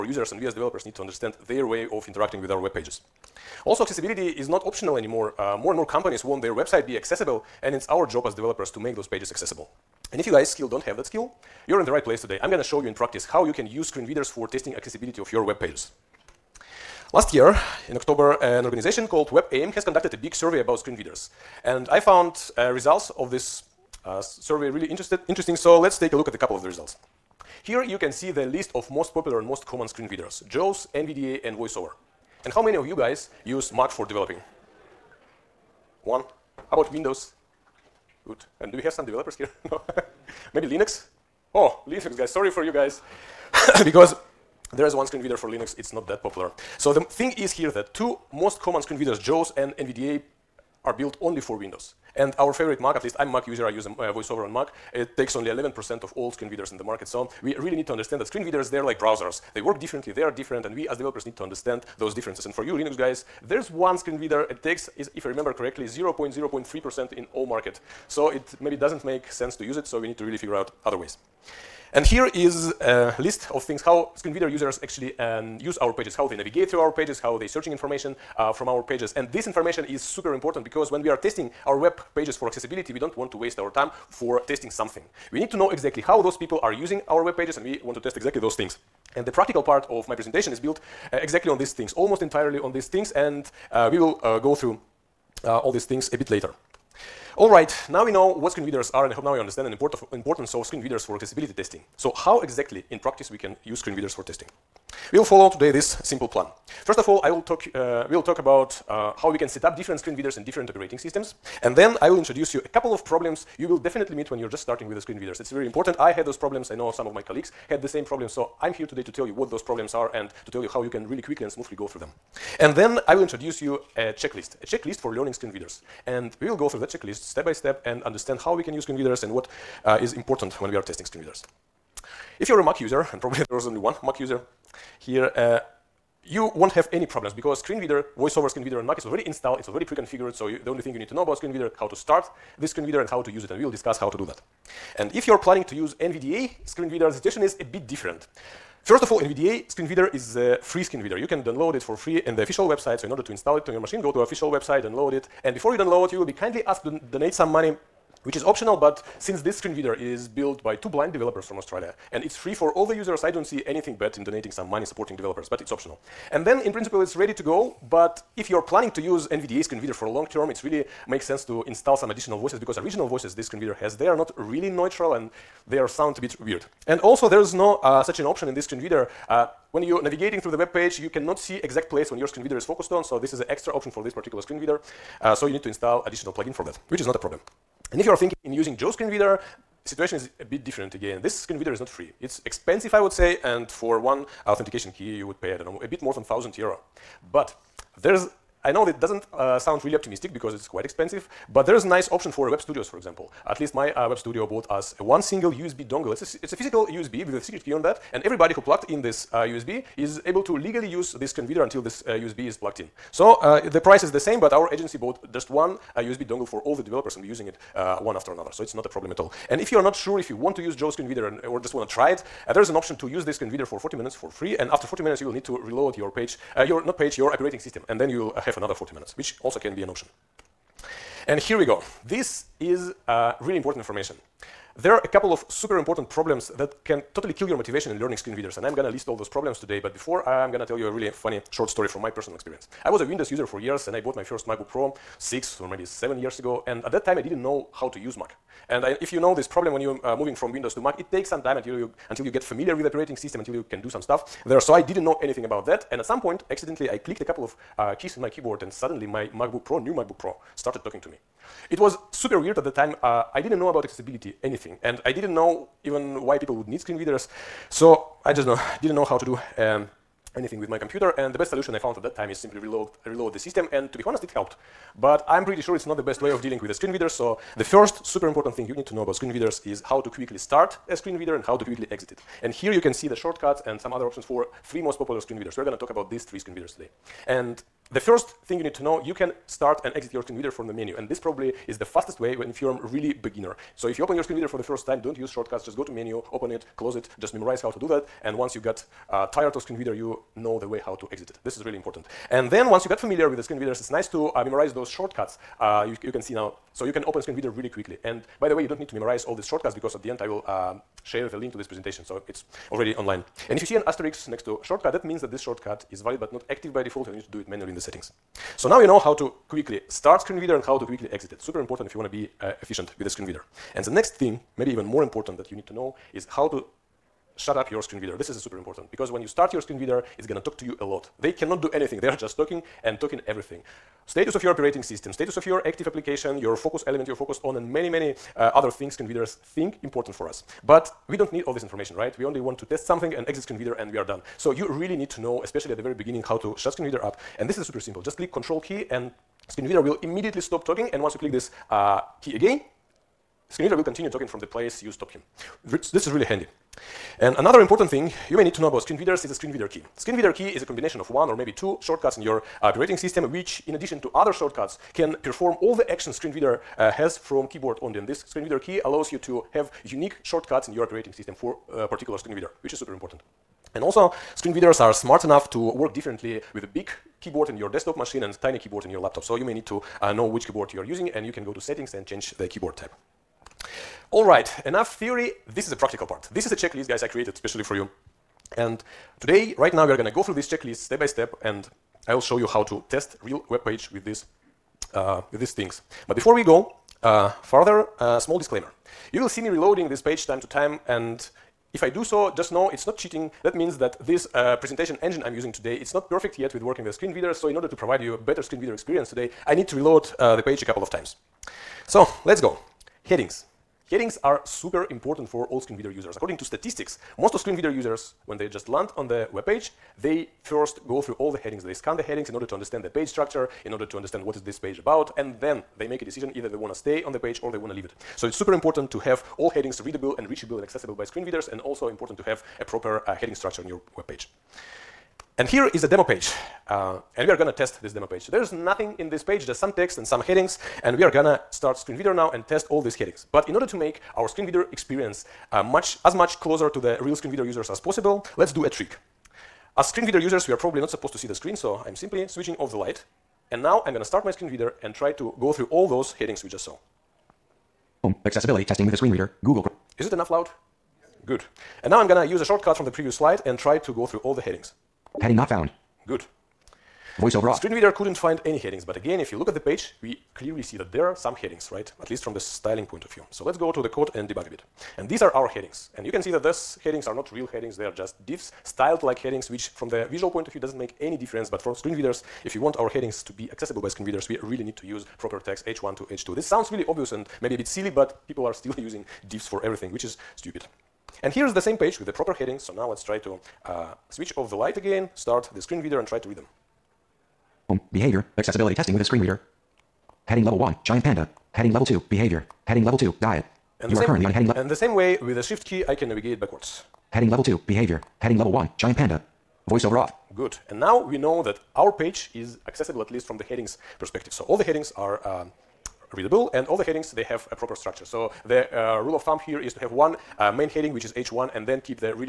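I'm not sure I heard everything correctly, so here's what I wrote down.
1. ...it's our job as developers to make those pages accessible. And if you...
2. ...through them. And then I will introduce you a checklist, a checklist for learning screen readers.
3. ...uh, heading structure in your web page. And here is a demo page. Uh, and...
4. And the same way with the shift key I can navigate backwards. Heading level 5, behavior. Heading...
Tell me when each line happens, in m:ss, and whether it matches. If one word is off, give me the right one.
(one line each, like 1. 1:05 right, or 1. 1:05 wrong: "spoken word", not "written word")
1. 0:07 right
2. 2:01 right
3. 7:13 right
4. 8:24 wrong: "2", not "5".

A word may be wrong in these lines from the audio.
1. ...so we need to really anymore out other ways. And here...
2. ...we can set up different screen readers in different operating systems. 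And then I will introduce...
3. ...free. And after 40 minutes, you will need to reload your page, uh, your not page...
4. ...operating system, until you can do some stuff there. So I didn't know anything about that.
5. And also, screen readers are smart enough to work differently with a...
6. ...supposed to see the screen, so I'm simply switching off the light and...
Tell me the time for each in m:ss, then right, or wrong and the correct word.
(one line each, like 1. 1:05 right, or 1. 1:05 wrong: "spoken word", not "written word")
1. 1:09 wrong: "figure", not "anymore"
2. 1:49 right
3. 3:44 right
4. 4:12 right
5. 6:13 right
6. 7:30 right.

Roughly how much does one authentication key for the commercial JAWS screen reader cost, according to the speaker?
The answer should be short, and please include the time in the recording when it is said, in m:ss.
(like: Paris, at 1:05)
a bit more than 1,000 euro, at 3:15.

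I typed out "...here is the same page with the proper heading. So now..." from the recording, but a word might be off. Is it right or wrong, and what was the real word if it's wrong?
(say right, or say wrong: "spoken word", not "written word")
right.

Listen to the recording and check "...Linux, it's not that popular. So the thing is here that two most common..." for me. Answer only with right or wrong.
right.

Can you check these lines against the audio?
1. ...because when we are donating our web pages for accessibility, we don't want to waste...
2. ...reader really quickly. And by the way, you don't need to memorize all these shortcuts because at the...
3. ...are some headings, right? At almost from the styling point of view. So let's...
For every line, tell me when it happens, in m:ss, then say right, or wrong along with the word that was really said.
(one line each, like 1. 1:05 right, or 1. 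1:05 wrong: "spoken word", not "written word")
1. 1:20 wrong: "testing", not "donating"
2. 5:07 right
3. 7:51 wrong: "least", not "almost".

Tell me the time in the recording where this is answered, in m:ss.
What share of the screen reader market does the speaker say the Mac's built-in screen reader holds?
0:55.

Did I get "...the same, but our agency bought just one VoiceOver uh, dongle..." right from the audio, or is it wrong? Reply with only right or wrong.
wrong.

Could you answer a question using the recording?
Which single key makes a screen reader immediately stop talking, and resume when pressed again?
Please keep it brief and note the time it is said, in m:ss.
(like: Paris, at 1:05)
Control, at 5:48.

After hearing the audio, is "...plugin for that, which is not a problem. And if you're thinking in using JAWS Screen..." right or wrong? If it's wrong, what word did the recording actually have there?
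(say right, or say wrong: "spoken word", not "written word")
right.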